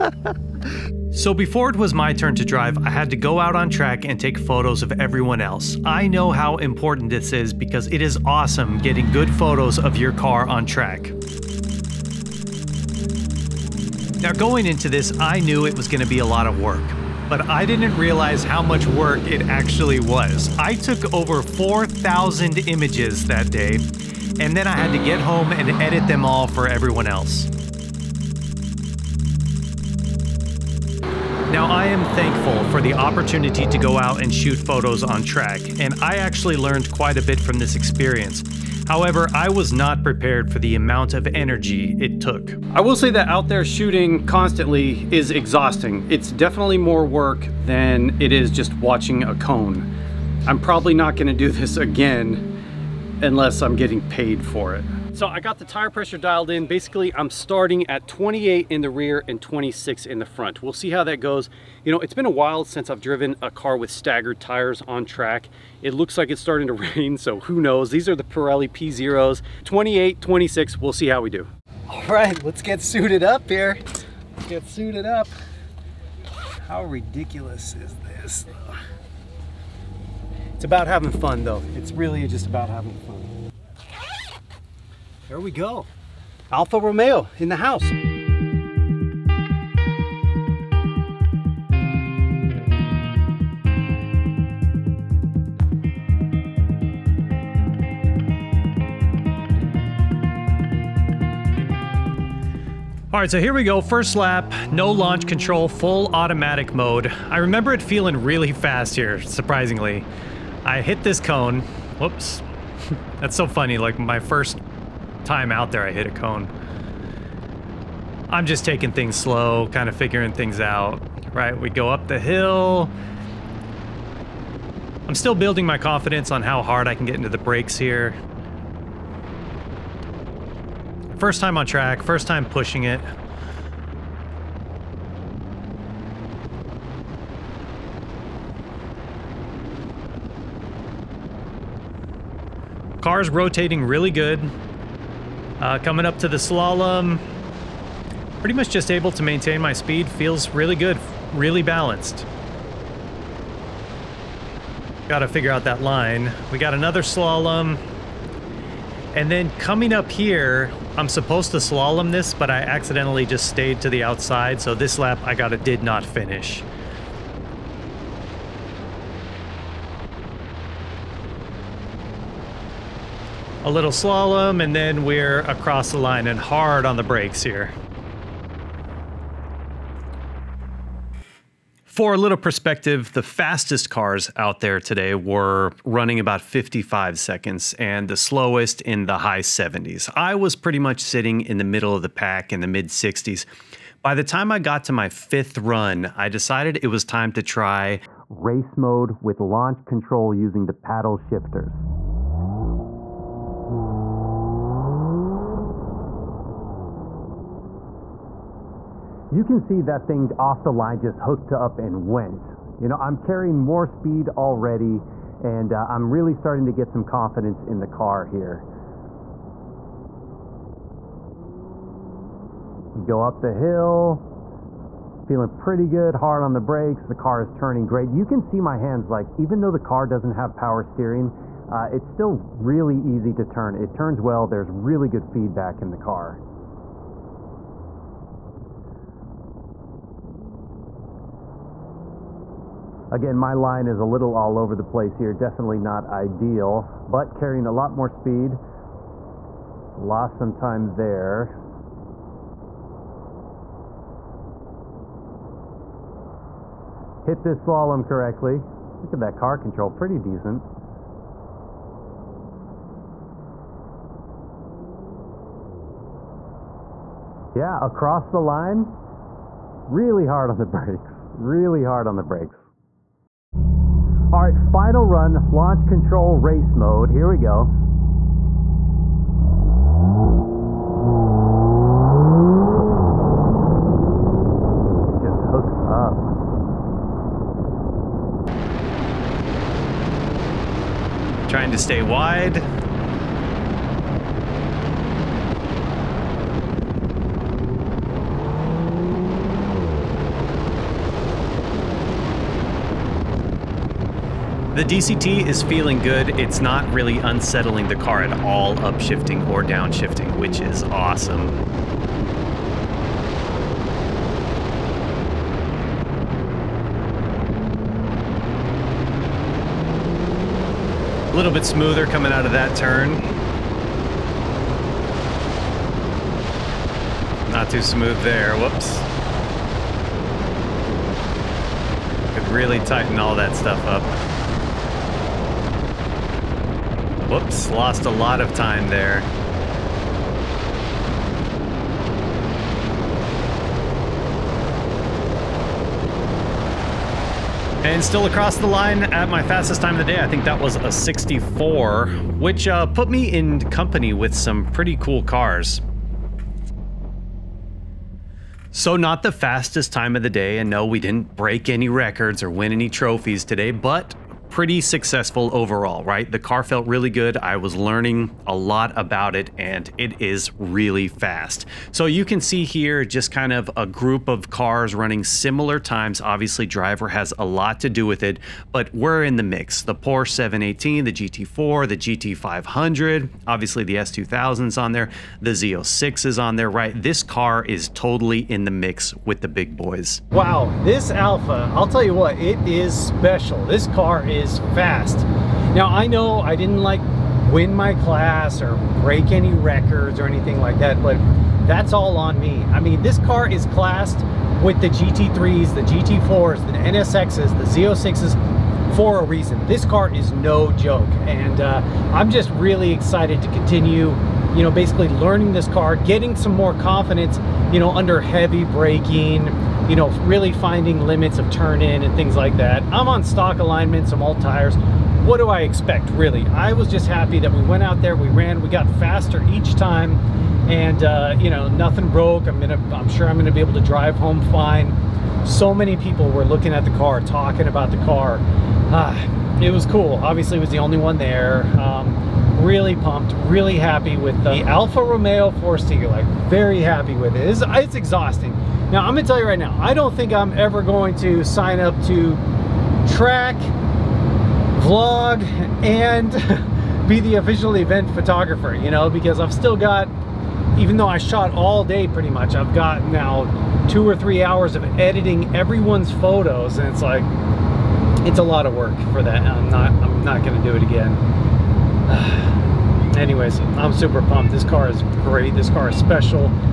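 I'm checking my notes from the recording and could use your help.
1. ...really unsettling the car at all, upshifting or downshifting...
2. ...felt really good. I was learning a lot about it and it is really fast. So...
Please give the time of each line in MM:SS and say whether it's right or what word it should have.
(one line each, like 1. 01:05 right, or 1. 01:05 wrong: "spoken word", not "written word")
1. 05:06 right
2. 06:06 right.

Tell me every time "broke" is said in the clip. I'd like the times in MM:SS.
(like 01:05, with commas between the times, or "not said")
07:12.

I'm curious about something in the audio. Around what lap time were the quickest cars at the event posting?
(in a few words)
55 seconds.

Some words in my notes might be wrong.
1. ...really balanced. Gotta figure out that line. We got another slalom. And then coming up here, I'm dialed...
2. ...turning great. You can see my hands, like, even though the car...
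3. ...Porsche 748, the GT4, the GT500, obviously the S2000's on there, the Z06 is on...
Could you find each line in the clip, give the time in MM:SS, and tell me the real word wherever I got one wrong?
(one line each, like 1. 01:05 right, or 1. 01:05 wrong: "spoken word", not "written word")
1. 02:31 wrong: "supposed", not "dialed"
2. 03:47 right
3. 06:19 wrong: "718", not "748".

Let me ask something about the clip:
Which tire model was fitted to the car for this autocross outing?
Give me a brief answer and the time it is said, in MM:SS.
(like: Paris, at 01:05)
Pirelli P0s, at 01:08.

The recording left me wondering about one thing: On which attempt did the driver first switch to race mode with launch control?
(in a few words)
fifth run.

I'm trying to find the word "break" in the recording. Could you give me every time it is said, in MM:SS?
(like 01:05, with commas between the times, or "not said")
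06:01, 06:39.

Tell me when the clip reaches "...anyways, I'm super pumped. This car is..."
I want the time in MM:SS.
07:53.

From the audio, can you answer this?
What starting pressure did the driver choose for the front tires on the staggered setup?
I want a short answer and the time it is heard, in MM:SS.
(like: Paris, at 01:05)
26, at 00:59.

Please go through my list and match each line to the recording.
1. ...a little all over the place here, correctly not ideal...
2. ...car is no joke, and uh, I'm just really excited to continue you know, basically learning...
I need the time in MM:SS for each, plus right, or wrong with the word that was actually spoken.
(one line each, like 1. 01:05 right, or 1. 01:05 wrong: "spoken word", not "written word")
1. 04:04 wrong: "definitely", not "correctly"
2. 06:49 right.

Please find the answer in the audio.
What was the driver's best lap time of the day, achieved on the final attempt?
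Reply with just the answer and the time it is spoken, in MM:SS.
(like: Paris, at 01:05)
64, at 05:50.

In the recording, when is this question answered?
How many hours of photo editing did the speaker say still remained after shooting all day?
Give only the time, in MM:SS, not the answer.
07:43.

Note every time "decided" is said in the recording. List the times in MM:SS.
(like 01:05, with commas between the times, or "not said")
03:16.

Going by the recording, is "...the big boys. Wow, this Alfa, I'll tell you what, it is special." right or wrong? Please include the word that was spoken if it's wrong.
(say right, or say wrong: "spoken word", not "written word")
right.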